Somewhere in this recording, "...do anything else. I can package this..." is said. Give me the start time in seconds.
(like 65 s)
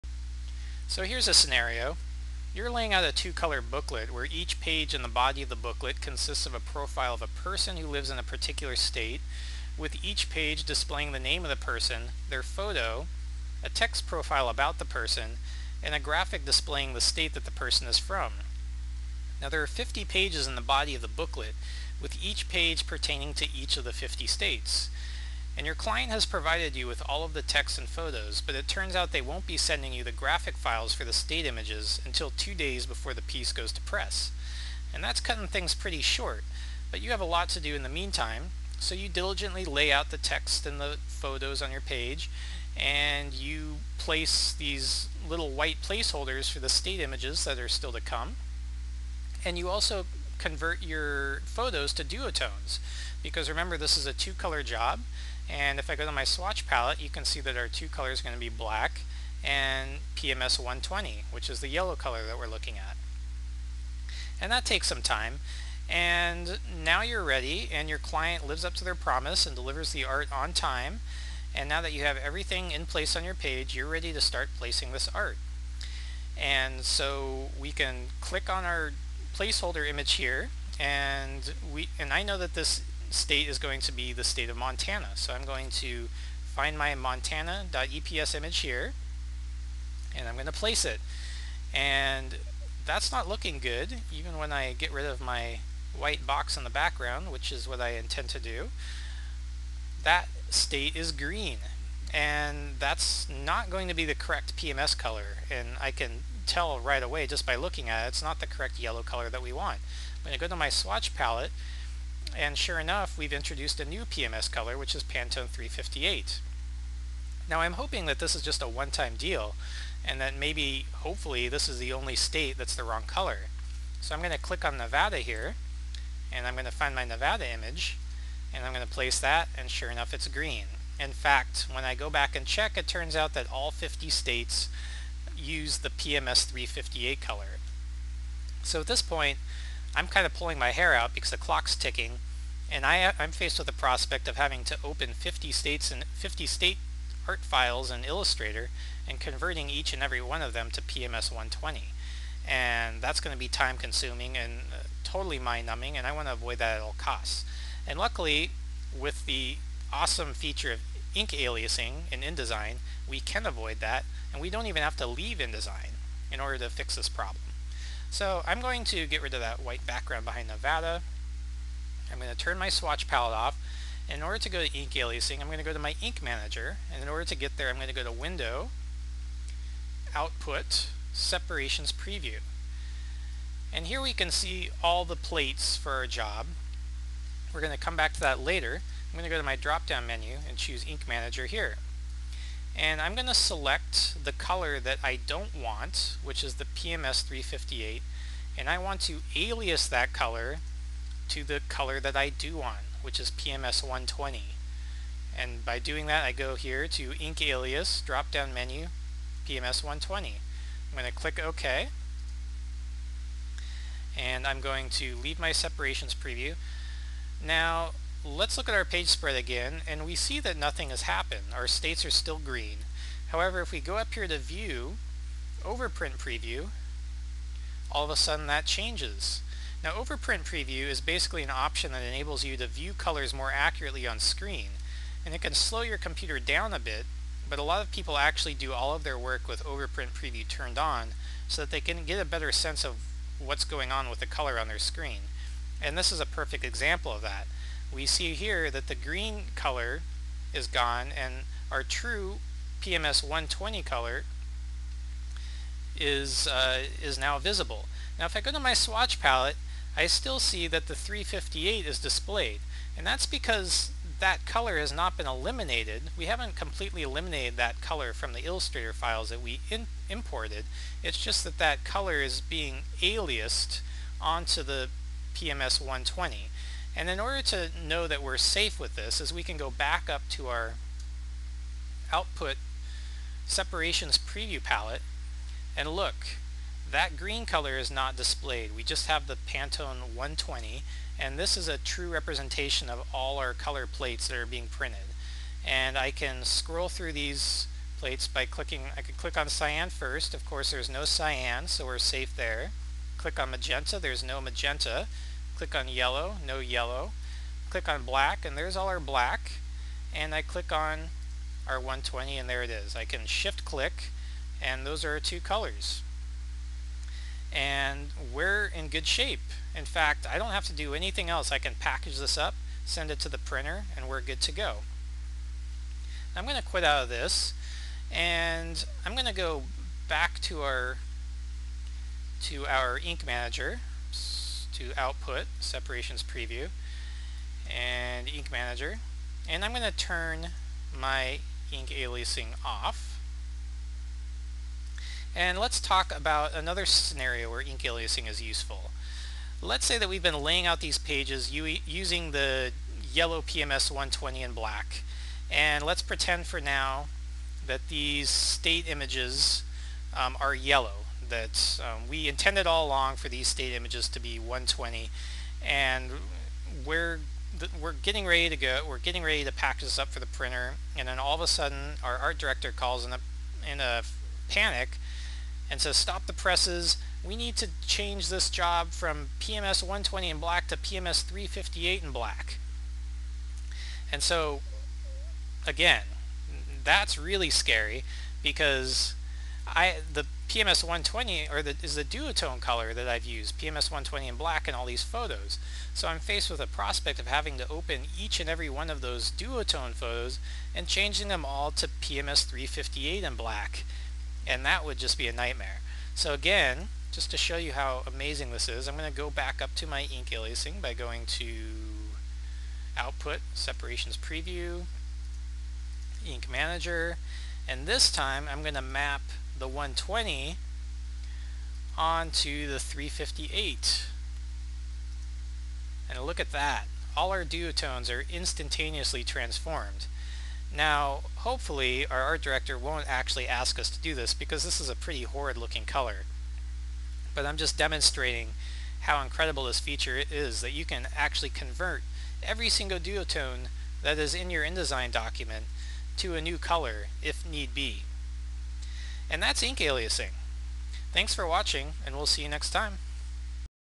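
320 s.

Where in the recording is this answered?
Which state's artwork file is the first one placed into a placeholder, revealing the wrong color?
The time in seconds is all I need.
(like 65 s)
86 s.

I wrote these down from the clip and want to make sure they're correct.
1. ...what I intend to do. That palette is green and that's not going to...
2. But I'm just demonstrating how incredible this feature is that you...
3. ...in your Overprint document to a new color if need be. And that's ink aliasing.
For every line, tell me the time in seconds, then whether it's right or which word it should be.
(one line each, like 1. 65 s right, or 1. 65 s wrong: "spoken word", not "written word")
1. 97 s wrong: "state", not "palette"
2. 437 s right
3. 444 s wrong: "InDesign", not "Overprint".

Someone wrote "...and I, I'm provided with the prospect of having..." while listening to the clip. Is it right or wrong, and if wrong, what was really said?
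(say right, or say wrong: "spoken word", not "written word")
wrong: "faced", not "provided".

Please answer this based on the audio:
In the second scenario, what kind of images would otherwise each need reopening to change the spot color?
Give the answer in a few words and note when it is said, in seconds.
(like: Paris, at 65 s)
duotone photos, at 399 s.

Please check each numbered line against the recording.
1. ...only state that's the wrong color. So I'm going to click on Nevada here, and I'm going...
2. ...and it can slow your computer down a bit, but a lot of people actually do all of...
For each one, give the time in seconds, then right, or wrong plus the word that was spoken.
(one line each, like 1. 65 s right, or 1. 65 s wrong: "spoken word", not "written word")
1. 121 s right
2. 235 s right.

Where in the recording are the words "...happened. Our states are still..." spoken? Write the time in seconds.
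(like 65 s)
221 s.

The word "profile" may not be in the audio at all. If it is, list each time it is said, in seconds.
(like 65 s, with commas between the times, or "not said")
6 s, 14 s.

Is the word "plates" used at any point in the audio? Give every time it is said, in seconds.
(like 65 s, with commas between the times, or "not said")
185 s, 293 s, 297 s.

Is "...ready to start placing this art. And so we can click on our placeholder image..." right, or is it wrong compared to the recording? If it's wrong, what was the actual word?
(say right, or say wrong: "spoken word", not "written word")
right.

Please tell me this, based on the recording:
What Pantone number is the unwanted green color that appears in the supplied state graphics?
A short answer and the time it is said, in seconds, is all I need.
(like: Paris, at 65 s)
Pantone 358, at 115 s.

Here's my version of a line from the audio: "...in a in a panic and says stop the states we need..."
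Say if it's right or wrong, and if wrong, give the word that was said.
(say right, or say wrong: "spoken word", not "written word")
wrong: "presses", not "states".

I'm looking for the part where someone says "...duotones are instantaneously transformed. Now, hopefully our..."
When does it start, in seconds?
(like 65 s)
427 s.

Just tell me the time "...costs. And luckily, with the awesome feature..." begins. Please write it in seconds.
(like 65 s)
156 s.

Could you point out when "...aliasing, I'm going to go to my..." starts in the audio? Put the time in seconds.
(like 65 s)
174 s.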